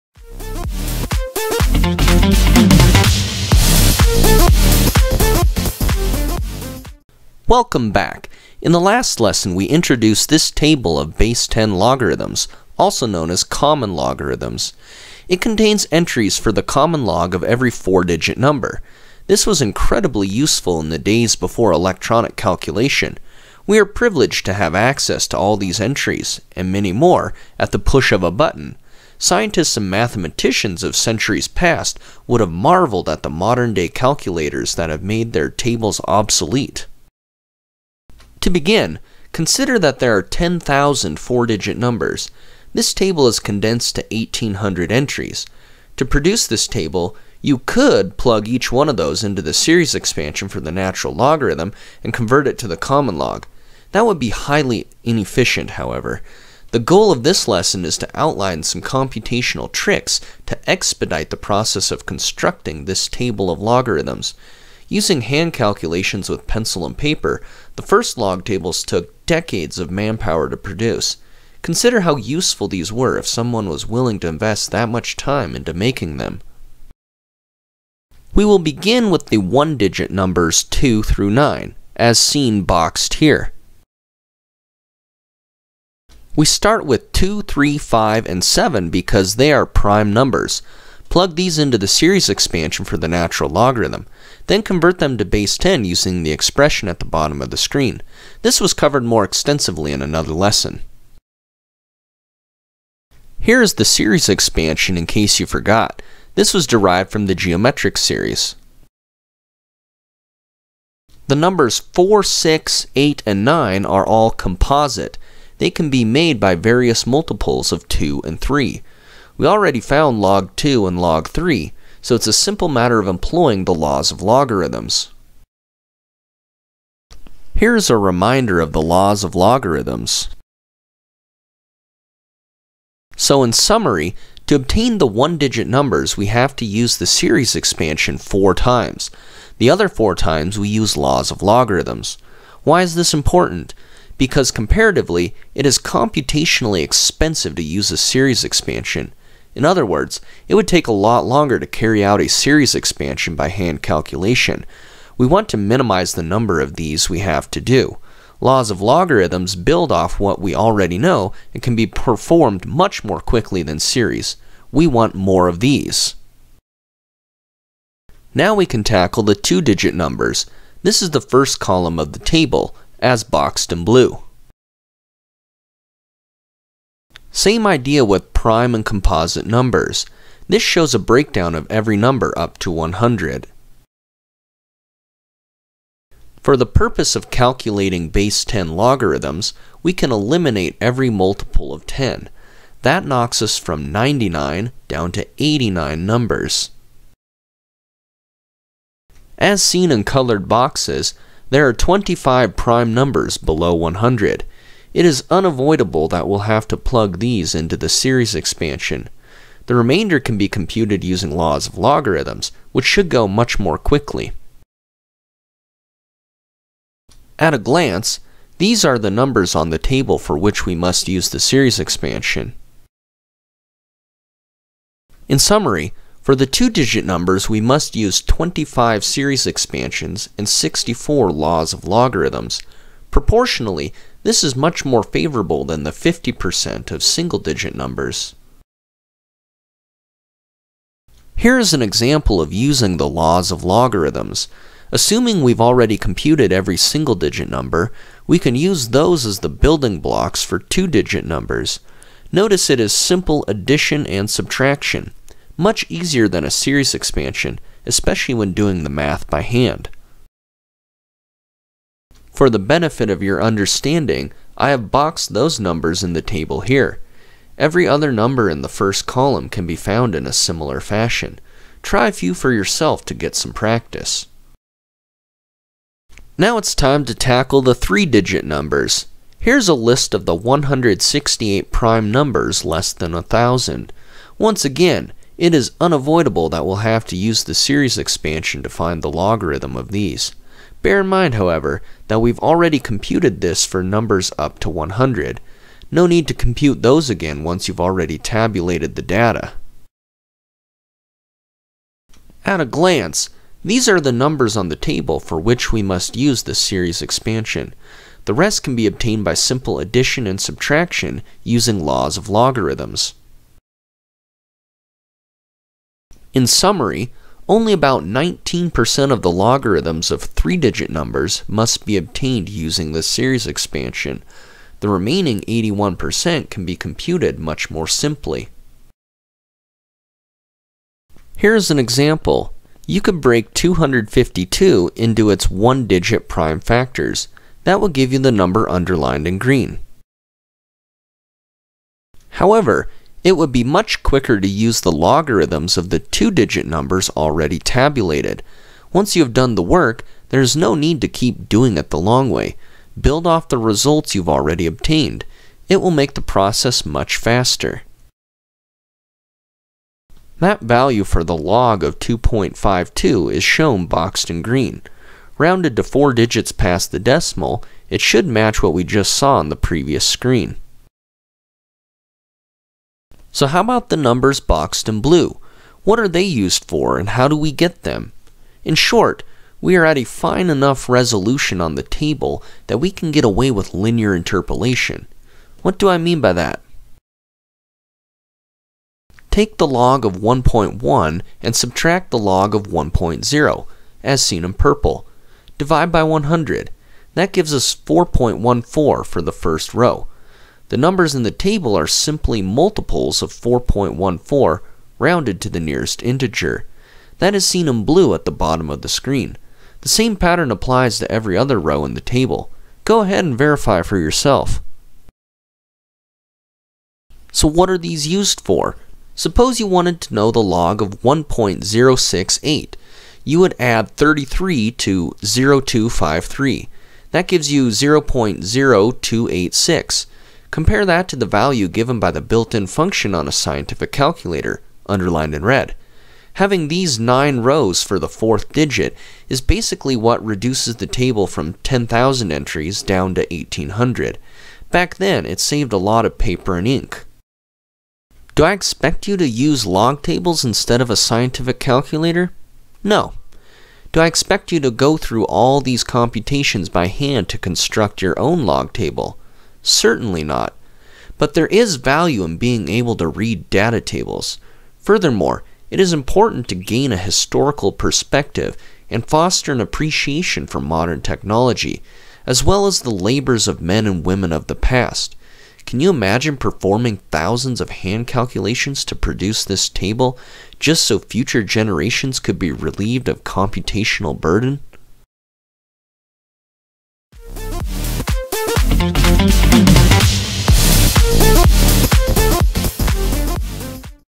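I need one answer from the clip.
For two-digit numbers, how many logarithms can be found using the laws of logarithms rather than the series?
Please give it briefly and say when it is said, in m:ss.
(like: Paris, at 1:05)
64, at 3:50.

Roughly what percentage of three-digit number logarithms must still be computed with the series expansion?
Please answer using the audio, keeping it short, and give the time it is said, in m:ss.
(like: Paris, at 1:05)
19%, at 5:18.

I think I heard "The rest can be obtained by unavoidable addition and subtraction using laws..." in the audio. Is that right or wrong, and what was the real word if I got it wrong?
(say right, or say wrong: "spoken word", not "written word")
wrong: "simple", not "unavoidable".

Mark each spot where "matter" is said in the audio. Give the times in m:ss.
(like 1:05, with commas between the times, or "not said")
2:02.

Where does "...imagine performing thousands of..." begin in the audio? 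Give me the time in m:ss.
7:55.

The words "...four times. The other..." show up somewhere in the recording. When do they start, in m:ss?
2:18.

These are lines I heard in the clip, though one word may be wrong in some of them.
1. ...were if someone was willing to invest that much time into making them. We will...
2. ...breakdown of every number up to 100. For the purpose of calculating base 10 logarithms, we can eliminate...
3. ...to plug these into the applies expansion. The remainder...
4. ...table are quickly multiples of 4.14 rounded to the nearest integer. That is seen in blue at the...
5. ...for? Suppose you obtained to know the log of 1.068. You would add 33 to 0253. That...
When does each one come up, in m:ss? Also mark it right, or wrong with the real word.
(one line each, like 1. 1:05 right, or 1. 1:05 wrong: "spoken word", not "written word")
1. 1:12 right
2. 3:00 right
3. 3:26 wrong: "series", not "applies"
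4. 6:41 wrong: "simply", not "quickly"
5. 6:58 wrong: "wanted", not "obtained".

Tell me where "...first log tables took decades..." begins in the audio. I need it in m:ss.
1:07.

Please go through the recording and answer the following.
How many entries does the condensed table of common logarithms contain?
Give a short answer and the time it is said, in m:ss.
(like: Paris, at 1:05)
1800, at 0:44.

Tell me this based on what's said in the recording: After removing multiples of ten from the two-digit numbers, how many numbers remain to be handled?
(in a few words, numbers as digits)
89.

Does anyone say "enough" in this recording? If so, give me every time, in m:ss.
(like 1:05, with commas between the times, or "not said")
6:20.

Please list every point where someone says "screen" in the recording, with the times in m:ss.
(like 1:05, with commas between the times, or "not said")
1:37, 6:10, 6:48.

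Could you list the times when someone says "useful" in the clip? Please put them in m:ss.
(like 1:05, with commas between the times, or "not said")
0:20, 1:12.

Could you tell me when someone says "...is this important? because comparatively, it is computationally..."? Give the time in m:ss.
2:22.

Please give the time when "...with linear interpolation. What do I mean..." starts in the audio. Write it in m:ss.
6:23.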